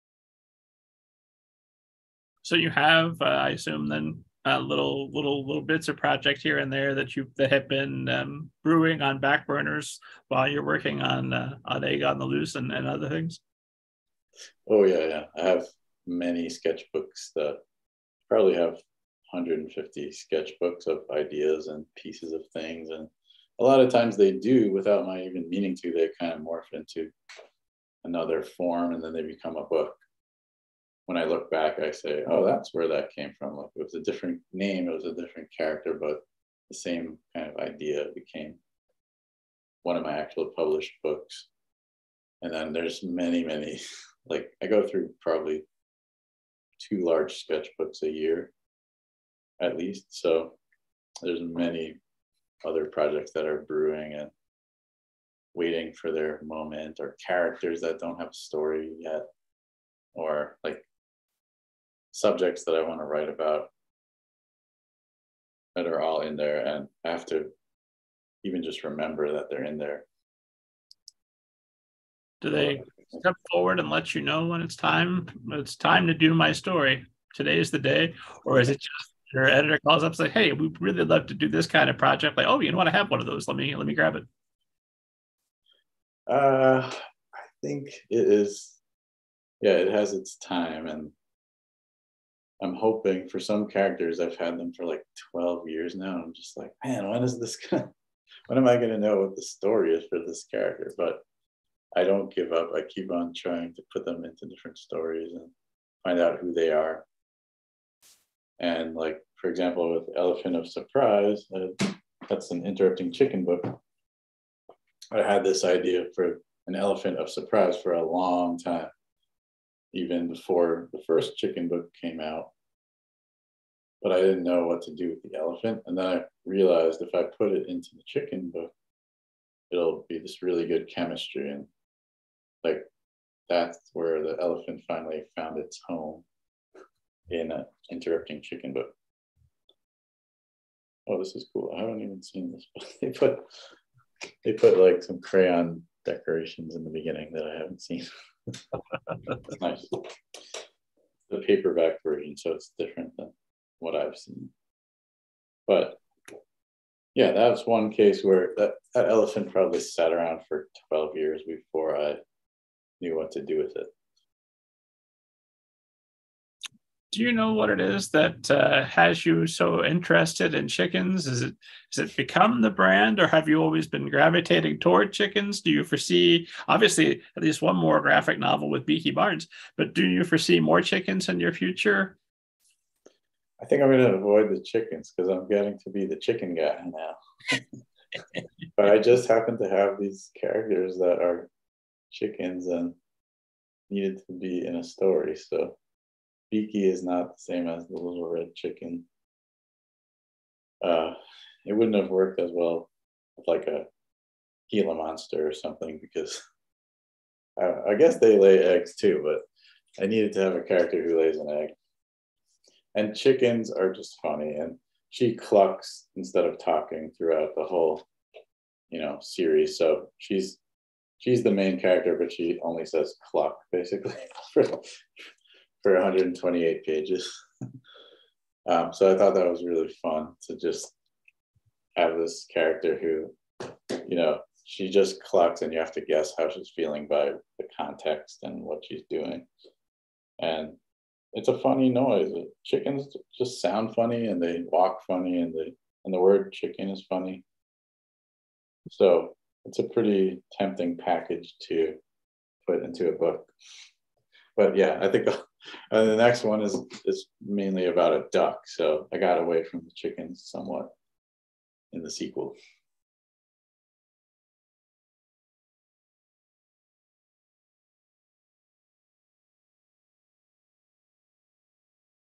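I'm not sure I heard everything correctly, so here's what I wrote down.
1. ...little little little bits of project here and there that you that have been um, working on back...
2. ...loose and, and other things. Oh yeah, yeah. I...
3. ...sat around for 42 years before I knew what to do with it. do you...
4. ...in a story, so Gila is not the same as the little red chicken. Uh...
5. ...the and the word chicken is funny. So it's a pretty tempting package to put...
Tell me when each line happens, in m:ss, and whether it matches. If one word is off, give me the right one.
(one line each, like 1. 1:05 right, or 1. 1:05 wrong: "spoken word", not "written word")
1. 0:04 wrong: "brewing", not "working"
2. 0:12 right
3. 2:39 wrong: "12", not "42"
4. 3:14 wrong: "Beaky", not "Gila"
5. 4:05 right.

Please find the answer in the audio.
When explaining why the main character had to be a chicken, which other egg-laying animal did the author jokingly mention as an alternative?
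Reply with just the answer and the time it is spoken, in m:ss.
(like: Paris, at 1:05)
Gila monster, at 3:24.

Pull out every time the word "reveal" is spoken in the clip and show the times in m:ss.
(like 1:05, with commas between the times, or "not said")
not said.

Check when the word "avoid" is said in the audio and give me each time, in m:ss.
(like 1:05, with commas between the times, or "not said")
3:04.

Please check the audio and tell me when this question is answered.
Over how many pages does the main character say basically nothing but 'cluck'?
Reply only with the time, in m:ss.
3:45.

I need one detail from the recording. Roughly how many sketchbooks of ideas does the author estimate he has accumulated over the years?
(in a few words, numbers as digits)
150.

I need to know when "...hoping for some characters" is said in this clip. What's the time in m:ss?
1:32.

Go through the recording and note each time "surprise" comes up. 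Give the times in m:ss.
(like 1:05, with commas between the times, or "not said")
1:50, 1:57.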